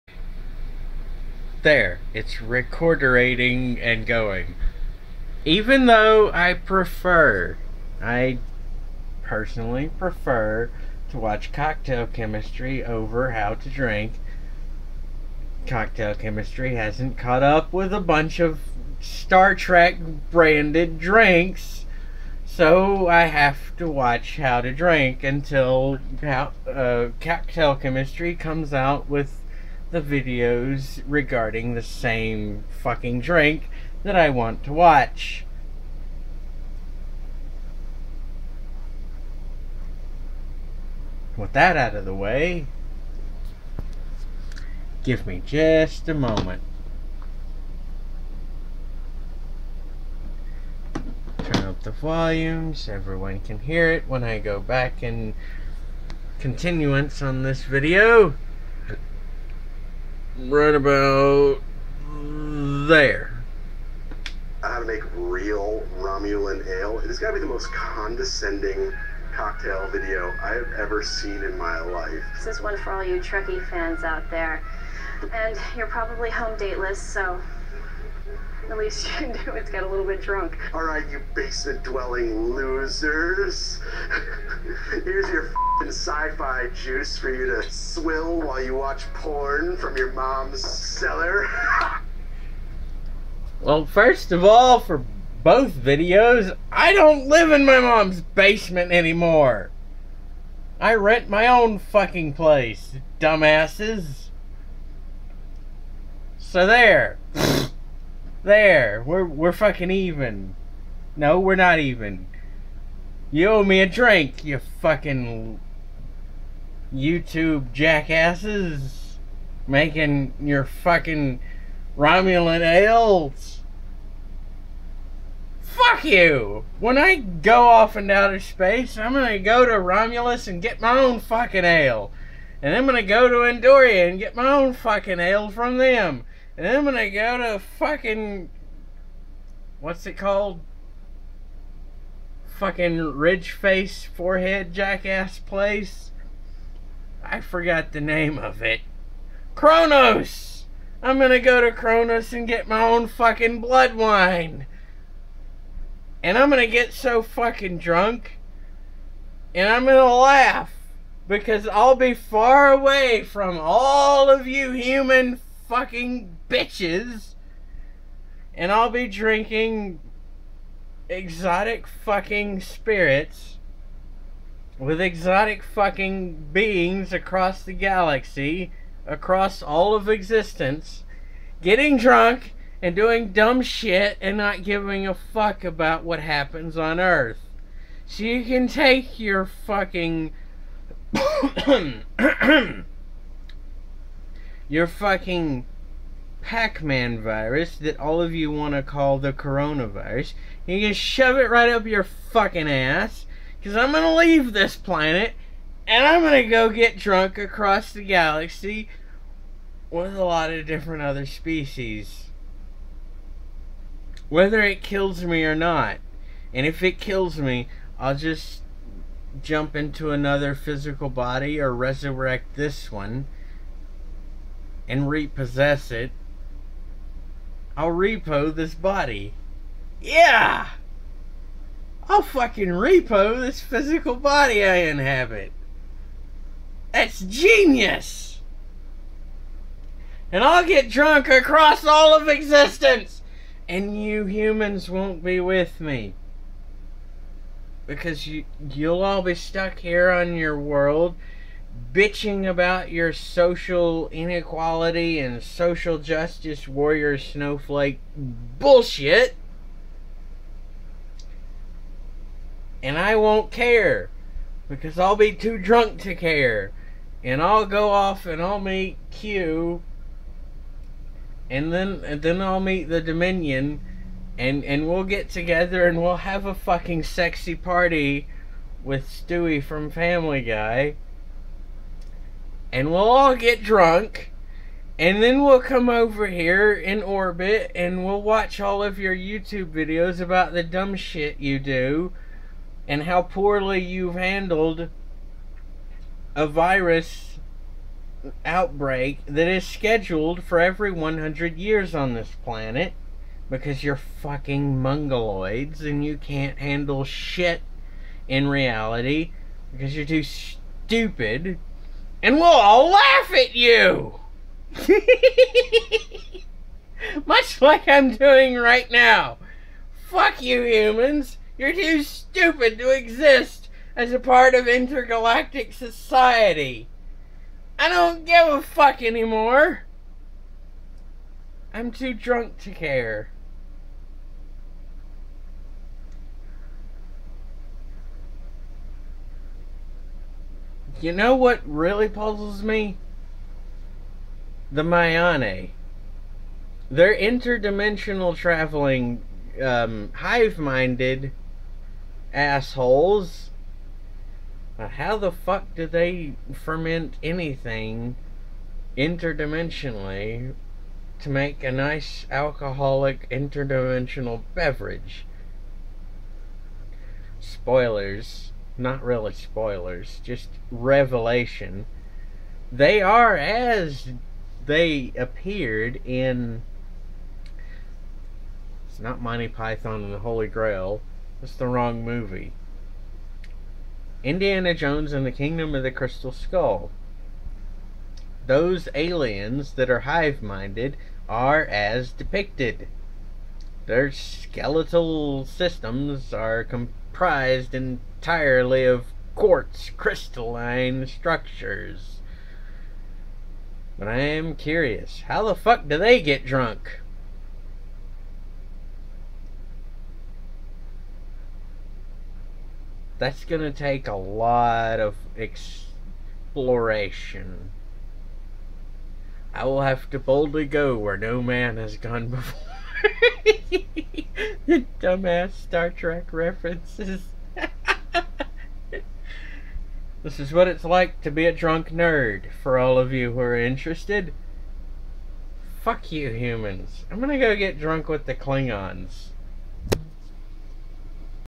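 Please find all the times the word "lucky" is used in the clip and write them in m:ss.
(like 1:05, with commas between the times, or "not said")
not said.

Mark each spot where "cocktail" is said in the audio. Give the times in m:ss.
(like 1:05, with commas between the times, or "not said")
0:11, 0:15, 0:27, 1:09.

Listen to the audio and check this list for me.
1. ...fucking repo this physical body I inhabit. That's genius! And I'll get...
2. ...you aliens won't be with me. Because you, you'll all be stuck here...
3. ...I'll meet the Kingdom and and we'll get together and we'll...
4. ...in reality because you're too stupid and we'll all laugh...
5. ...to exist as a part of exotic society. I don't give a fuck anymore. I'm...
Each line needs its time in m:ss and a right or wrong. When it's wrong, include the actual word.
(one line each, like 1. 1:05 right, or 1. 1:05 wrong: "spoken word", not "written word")
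1. 3:52 right
2. 4:04 wrong: "humans", not "aliens"
3. 4:32 wrong: "Dominion", not "Kingdom"
4. 5:08 right
5. 5:22 wrong: "intergalactic", not "exotic".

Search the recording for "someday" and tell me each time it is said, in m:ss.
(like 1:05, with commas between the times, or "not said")
not said.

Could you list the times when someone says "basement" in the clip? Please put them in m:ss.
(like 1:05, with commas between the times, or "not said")
1:21, 1:38.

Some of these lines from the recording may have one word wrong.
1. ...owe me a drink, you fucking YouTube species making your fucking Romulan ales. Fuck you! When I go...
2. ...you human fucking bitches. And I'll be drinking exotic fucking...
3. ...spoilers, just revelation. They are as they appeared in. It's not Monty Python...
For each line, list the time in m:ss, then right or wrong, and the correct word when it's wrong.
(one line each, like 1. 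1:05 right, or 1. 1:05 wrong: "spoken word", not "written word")
1. 1:53 wrong: "jackasses", not "species"
2. 2:44 right
3. 6:09 right.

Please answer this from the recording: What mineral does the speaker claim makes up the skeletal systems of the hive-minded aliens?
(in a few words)
quartz.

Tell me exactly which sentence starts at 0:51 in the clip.
Turn up the volumes; everyone can hear it when I go back in continuance on this video right about there.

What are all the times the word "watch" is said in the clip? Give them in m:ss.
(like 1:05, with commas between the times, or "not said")
0:11, 0:23, 0:34, 1:28, 4:48.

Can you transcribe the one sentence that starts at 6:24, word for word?
Indiana Jones and the Kingdom of the Crystal Skull.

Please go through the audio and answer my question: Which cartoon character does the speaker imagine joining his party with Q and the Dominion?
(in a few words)
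Stewie.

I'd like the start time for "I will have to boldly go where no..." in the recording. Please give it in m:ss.
6:59.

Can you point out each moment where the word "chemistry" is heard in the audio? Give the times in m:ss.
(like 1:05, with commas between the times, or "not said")
0:12, 0:16, 0:27.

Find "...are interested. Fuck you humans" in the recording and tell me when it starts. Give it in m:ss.
7:13.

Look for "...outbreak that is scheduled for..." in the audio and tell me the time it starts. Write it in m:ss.
4:58.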